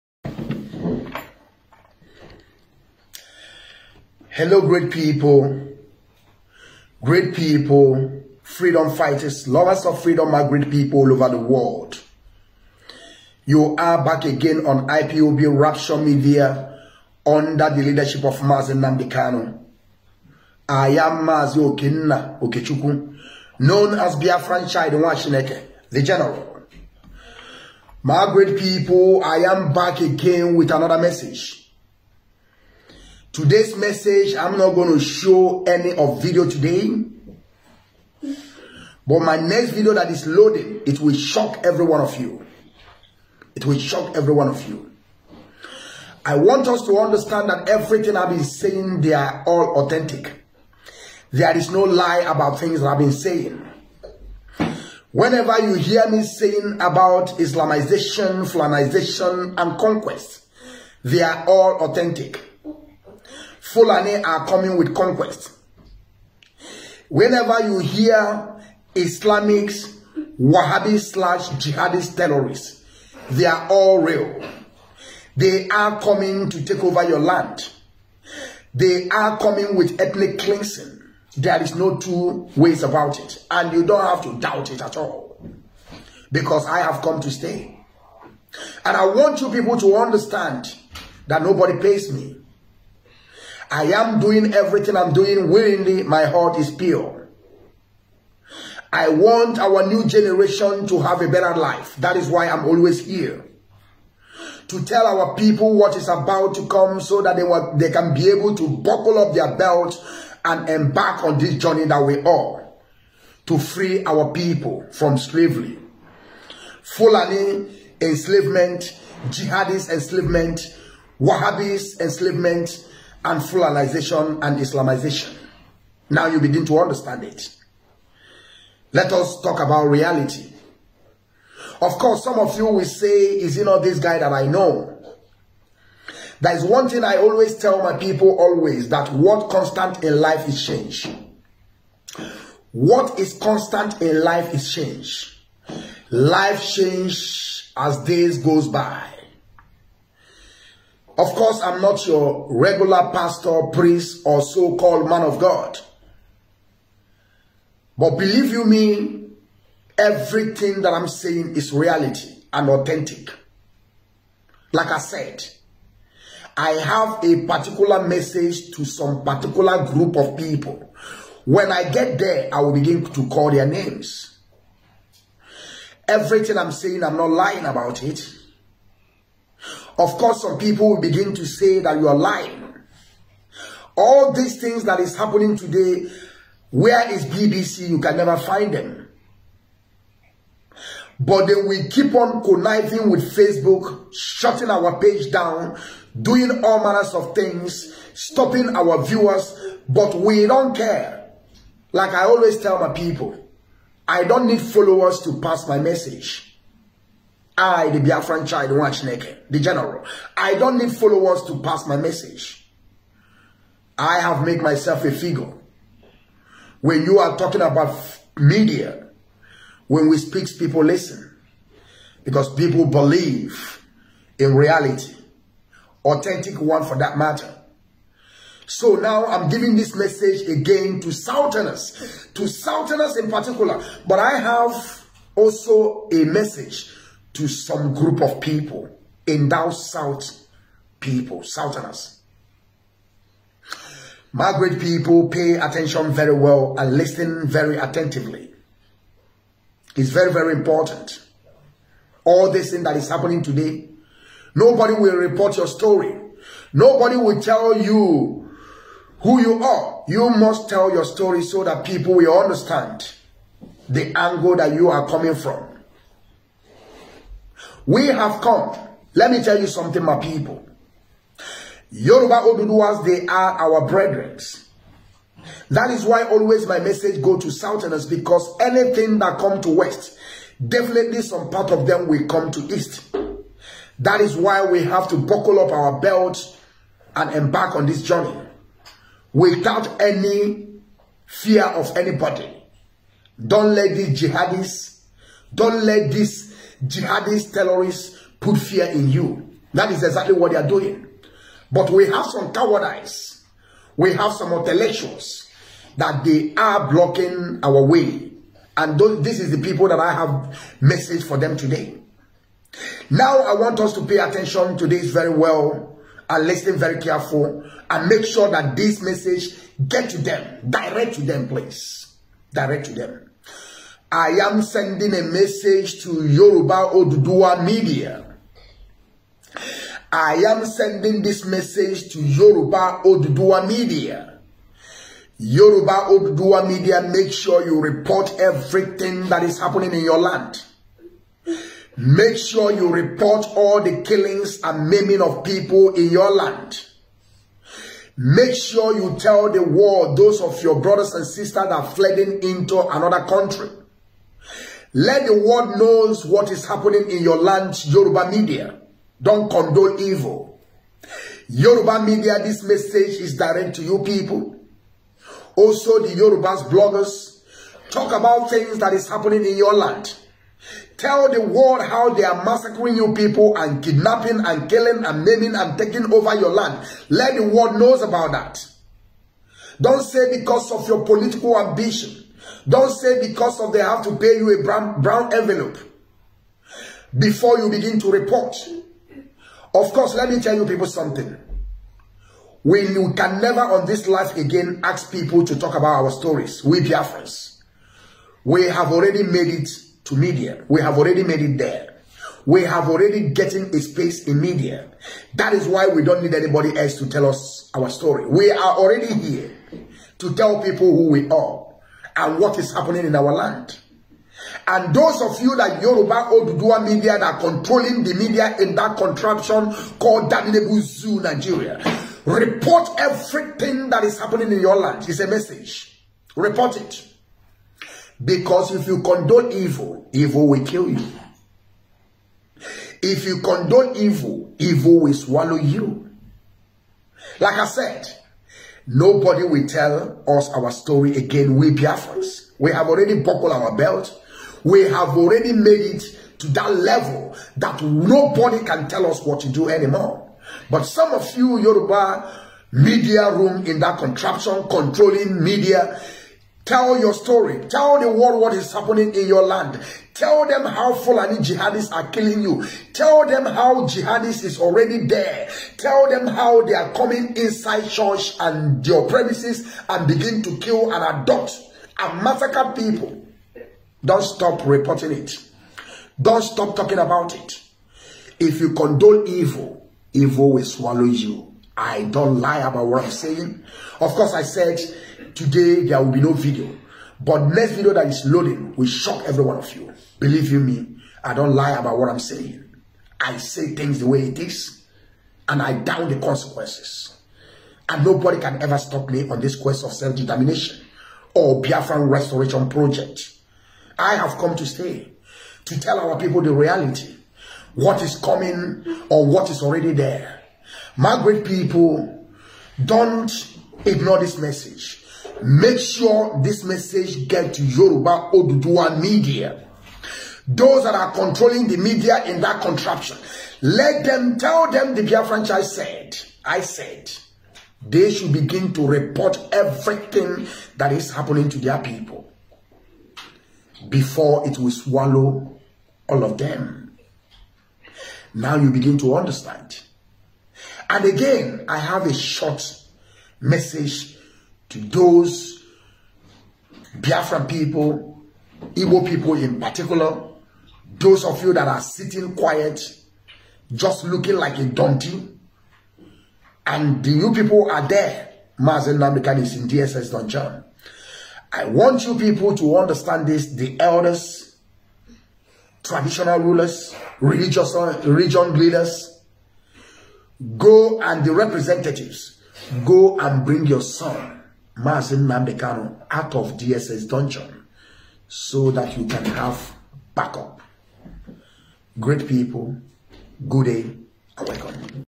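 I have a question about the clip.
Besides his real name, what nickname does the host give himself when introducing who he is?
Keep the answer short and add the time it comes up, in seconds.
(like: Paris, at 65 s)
Biafran Child Nwashineke, at 24 s.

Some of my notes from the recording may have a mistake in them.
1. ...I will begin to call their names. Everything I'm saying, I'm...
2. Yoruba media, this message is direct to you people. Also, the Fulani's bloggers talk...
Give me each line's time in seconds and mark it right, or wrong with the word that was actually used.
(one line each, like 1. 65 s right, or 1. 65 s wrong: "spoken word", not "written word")
1. 172 s right
2. 361 s wrong: "Yoruba", not "Fulani".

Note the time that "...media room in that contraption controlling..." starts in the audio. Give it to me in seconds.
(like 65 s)
452 s.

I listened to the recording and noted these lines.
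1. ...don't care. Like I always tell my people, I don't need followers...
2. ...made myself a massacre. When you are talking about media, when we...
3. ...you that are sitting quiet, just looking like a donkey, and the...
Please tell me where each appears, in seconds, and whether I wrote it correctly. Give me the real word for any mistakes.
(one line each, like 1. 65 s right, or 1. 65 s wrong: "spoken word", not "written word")
1. 200 s right
2. 214 s wrong: "figure", not "massacre"
3. 551 s right.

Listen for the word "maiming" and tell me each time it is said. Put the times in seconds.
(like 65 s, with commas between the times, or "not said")
344 s, 375 s.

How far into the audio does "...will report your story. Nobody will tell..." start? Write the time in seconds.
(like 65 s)
254 s.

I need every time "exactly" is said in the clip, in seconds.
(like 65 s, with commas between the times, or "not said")
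300 s.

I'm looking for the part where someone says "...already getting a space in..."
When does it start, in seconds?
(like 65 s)
402 s.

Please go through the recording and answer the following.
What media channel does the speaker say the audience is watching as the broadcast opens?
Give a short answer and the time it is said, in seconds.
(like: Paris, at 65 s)
IPOB Rapture Media, at 14 s.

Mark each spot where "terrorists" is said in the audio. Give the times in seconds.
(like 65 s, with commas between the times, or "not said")
72 s, 297 s.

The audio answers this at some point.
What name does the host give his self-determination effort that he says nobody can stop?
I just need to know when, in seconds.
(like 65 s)
501 s.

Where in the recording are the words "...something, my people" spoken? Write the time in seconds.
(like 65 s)
269 s.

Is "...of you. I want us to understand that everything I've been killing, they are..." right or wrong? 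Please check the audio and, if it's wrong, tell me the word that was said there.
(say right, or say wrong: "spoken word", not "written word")
wrong: "saying", not "killing".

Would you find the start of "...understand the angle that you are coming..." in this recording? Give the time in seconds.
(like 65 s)
262 s.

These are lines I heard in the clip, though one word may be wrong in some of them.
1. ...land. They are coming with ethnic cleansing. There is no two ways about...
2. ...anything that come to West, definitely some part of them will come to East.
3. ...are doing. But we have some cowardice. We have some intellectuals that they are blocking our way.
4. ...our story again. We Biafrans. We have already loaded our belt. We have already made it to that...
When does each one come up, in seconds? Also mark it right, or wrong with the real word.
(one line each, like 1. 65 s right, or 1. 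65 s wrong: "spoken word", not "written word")
1. 77 s right
2. 278 s right
3. 300 s right
4. 440 s wrong: "buckled", not "loaded".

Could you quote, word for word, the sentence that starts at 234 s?
But I have also a message to some group of people in thou South people, Southerners.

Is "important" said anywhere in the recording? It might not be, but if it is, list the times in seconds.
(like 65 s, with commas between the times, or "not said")
250 s.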